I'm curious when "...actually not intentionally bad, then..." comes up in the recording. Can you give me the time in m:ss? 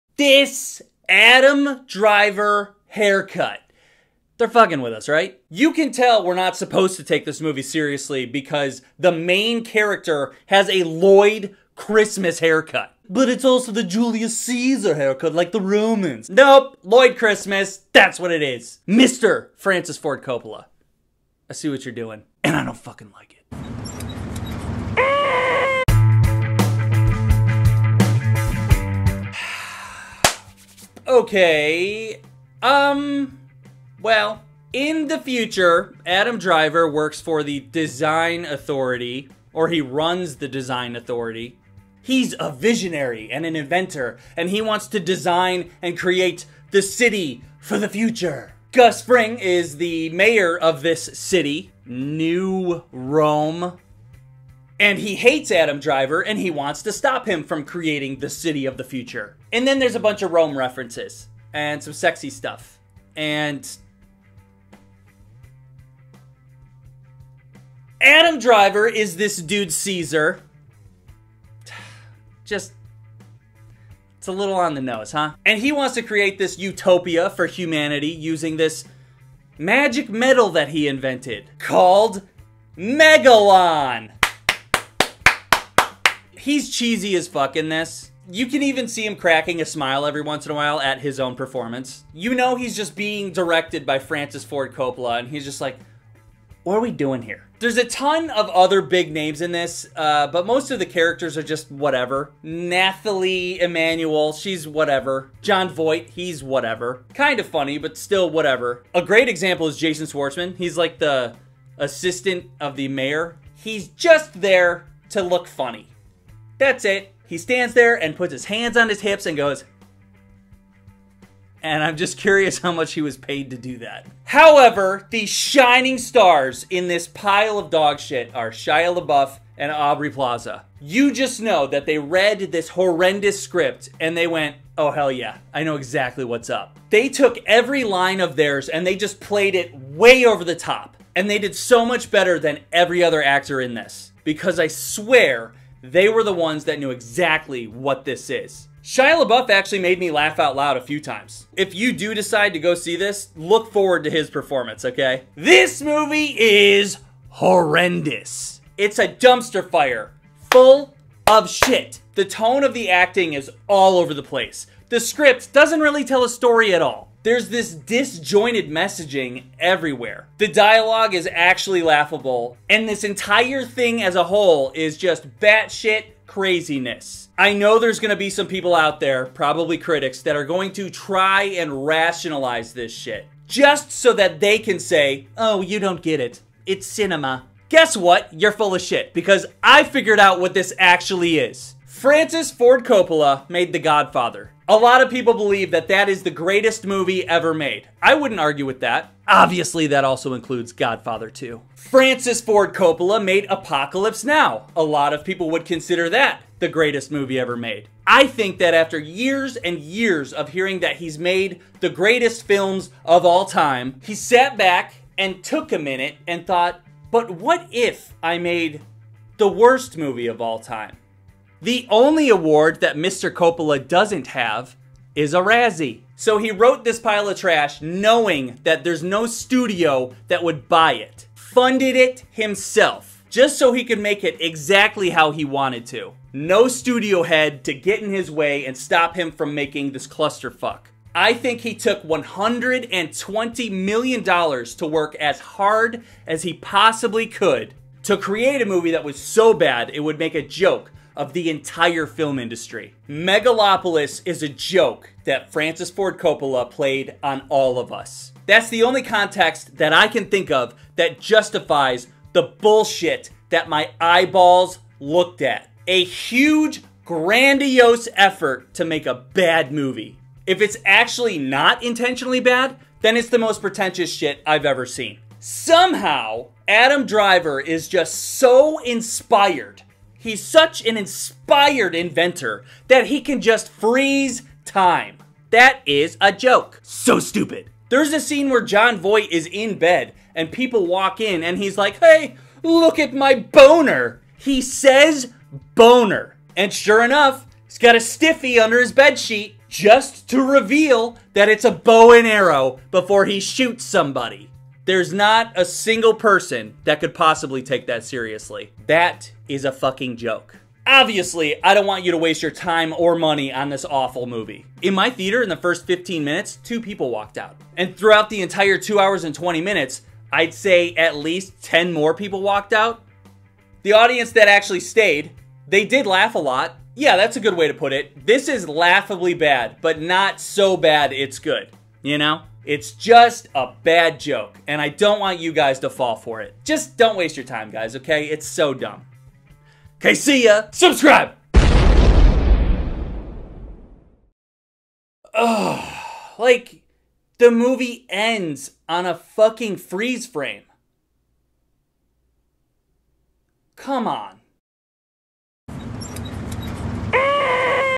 4:30.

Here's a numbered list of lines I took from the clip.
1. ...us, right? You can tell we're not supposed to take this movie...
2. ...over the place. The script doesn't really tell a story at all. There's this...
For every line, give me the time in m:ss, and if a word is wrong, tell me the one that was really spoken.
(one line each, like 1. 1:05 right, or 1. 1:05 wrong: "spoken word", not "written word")
1. 0:04 right
2. 2:43 right.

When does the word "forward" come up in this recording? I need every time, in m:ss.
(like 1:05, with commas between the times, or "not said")
2:33.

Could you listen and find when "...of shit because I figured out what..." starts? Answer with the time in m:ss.
3:08.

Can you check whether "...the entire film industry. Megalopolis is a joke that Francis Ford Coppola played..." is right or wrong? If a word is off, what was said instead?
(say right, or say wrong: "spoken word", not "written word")
right.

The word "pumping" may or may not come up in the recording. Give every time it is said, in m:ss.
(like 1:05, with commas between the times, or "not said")
not said.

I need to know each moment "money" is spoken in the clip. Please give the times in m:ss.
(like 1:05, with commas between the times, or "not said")
5:13.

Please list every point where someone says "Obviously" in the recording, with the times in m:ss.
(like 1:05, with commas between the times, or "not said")
3:19, 5:10.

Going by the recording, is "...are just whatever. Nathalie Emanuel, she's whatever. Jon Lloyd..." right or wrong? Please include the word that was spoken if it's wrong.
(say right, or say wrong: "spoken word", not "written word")
wrong: "Voight", not "Lloyd".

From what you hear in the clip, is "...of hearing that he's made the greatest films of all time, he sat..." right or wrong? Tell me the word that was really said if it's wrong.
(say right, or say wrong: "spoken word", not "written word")
right.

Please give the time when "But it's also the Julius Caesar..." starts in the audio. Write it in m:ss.
0:13.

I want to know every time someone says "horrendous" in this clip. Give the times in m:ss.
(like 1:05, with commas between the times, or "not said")
2:12, 2:37.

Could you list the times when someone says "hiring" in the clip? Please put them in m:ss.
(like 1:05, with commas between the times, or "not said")
not said.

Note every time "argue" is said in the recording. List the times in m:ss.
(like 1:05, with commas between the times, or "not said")
3:18.